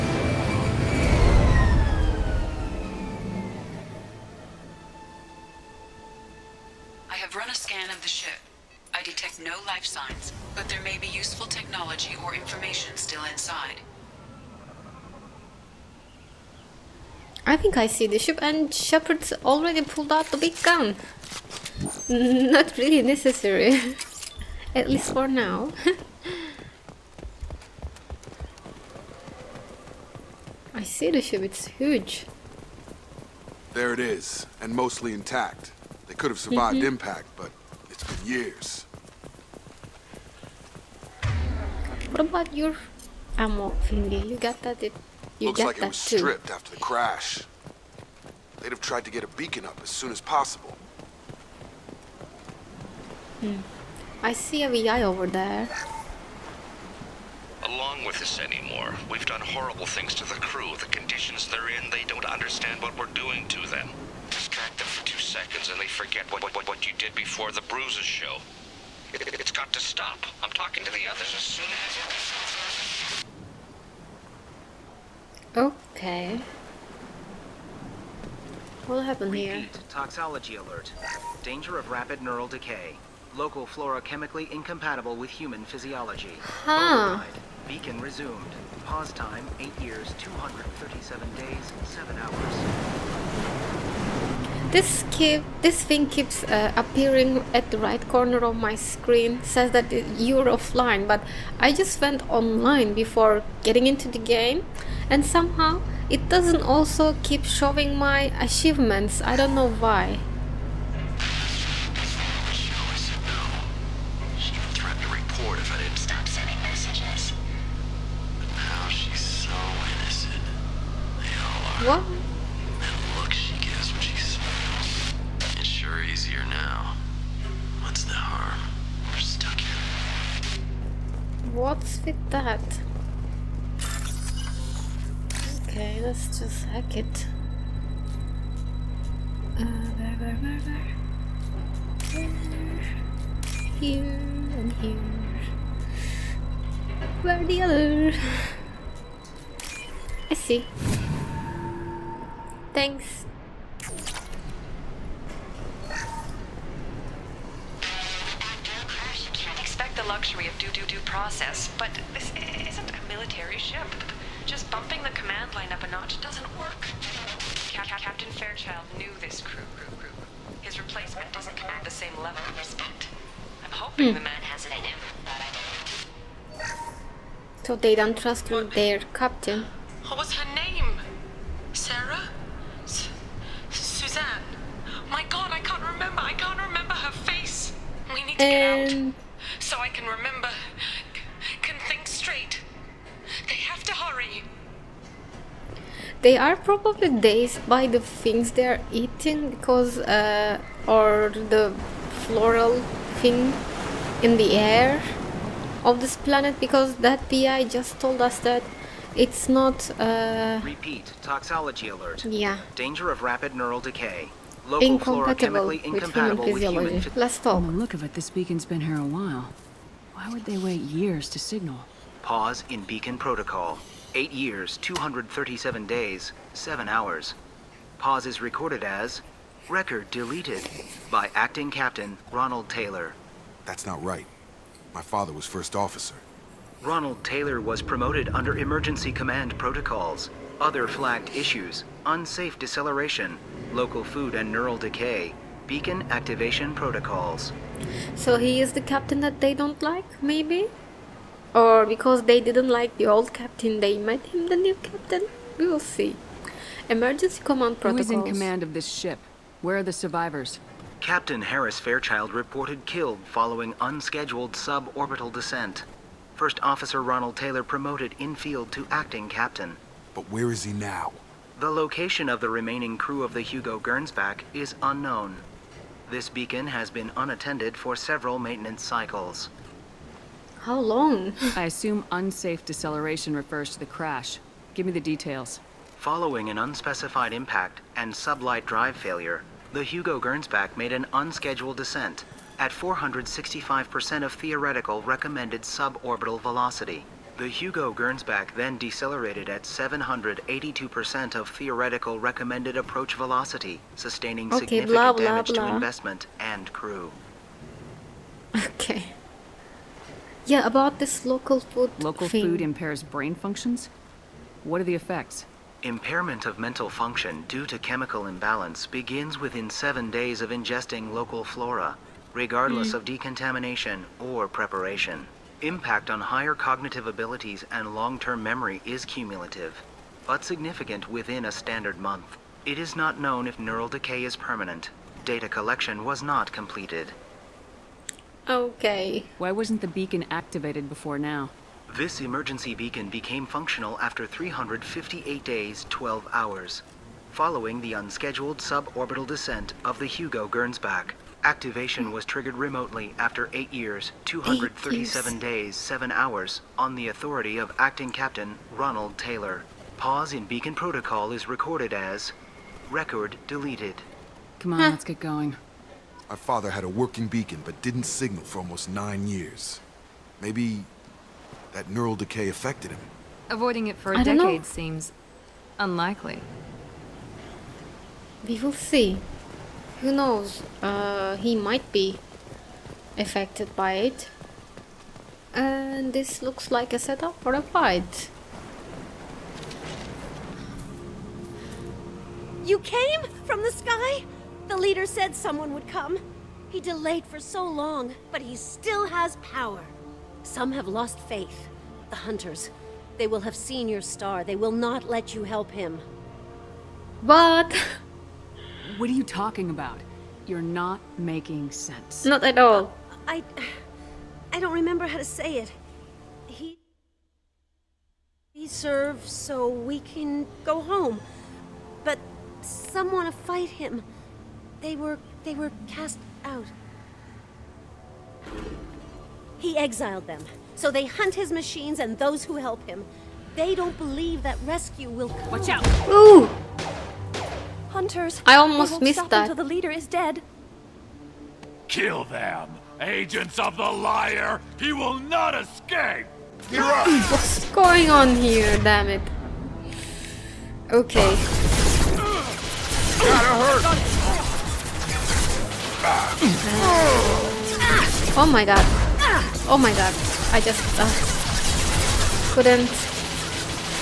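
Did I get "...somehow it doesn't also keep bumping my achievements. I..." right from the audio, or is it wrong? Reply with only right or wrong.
wrong.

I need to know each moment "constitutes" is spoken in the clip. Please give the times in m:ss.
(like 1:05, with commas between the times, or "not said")
not said.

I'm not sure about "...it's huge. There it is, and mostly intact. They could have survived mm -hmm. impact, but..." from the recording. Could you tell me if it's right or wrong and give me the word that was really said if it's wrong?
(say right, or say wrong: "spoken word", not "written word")
right.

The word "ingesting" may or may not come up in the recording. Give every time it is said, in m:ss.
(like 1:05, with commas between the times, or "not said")
5:20.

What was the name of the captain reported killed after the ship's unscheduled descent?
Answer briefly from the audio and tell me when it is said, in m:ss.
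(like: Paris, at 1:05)
Harris Fairchild, at 4:21.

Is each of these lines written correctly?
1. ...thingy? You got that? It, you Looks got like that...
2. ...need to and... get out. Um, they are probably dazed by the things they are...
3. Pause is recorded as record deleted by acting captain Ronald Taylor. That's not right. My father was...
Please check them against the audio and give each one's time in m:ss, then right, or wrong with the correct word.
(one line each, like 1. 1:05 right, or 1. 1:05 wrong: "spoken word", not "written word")
1. 0:43 right
2. 3:08 right
3. 3:47 right.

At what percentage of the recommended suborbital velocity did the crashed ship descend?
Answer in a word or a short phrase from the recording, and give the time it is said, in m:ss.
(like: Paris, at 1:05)
465%, at 4:52.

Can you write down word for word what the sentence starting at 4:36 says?
This beacon has been unattended for several maintenance cycles.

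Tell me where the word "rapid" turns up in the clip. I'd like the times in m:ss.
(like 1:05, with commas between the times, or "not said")
1:21, 3:33.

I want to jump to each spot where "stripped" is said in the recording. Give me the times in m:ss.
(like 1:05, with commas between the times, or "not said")
0:46.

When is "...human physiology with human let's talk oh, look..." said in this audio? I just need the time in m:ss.
3:36.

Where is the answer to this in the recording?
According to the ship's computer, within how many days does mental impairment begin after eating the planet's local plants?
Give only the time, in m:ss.
5:19.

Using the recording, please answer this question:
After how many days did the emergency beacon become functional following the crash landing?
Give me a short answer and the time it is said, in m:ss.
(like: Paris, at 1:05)
358 days, at 5:44.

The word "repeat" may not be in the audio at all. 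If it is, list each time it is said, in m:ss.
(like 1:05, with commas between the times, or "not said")
1:19, 3:30.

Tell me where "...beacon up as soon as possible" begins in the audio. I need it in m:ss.
0:49.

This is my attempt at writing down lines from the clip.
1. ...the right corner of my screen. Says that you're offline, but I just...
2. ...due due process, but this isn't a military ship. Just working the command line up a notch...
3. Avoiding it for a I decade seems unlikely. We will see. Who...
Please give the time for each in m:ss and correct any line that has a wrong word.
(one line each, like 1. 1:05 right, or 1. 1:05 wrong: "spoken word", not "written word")
1. 1:37 right
2. 2:40 wrong: "bumping", not "working"
3. 6:13 right.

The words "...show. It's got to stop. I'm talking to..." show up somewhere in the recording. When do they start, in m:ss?
1:08.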